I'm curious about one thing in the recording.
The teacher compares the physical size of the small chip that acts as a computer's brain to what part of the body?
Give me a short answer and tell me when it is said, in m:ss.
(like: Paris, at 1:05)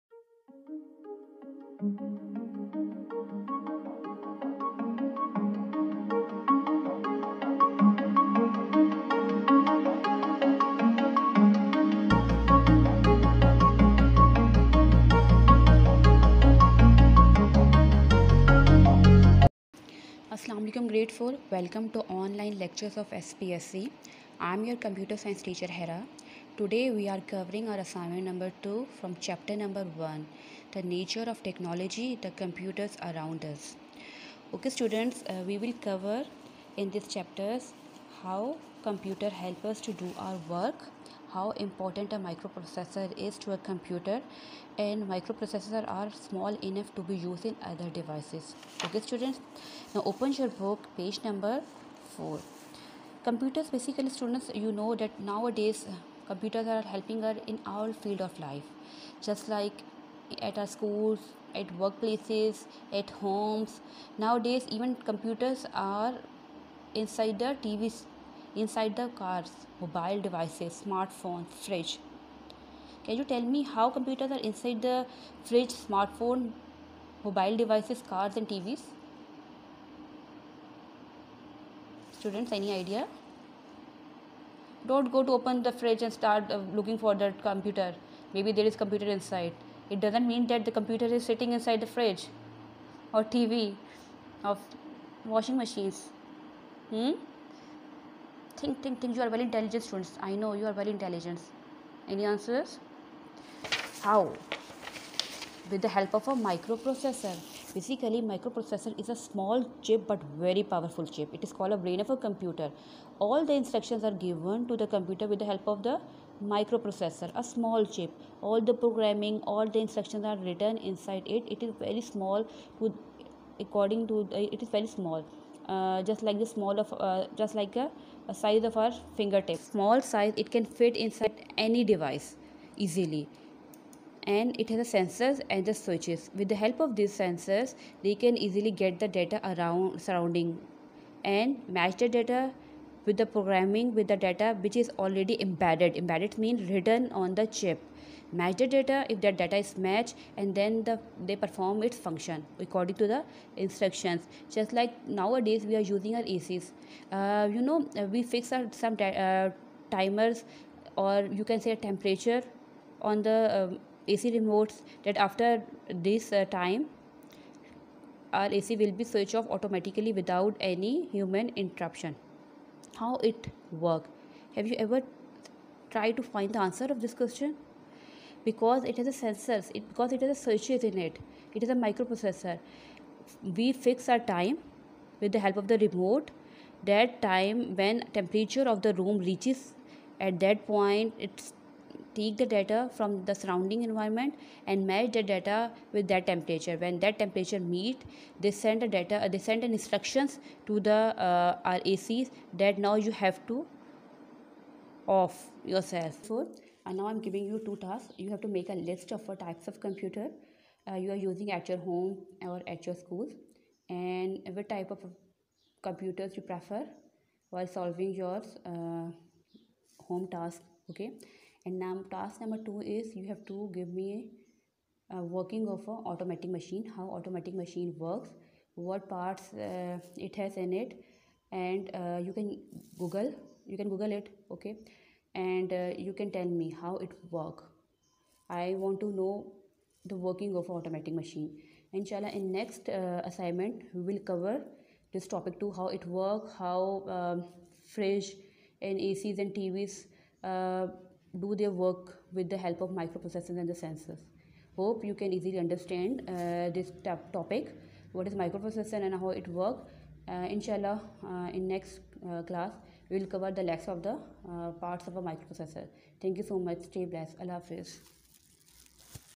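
fingertip, at 2:09.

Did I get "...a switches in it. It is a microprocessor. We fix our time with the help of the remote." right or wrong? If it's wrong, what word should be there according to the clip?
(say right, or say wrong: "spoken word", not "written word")
right.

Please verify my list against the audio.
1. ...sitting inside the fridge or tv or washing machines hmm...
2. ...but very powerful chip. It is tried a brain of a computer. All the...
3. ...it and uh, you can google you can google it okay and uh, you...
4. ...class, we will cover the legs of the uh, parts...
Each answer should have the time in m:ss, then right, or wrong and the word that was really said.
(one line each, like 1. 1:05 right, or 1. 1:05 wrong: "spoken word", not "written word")
1. 1:31 right
2. 1:50 wrong: "called", not "tried"
3. 3:50 right
4. 4:22 right.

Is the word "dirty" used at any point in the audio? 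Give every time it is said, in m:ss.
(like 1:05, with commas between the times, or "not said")
not said.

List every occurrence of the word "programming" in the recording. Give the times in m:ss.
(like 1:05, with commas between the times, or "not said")
1:58, 2:23.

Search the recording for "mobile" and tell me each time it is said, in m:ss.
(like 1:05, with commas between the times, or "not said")
1:09, 1:17.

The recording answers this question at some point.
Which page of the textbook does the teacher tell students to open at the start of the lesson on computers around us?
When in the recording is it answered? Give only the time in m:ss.
0:51.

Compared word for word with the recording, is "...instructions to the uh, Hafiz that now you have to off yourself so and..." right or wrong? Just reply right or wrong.
wrong.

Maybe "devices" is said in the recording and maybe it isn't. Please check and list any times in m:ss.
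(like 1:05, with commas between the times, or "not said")
0:47, 1:10, 1:17, 2:11.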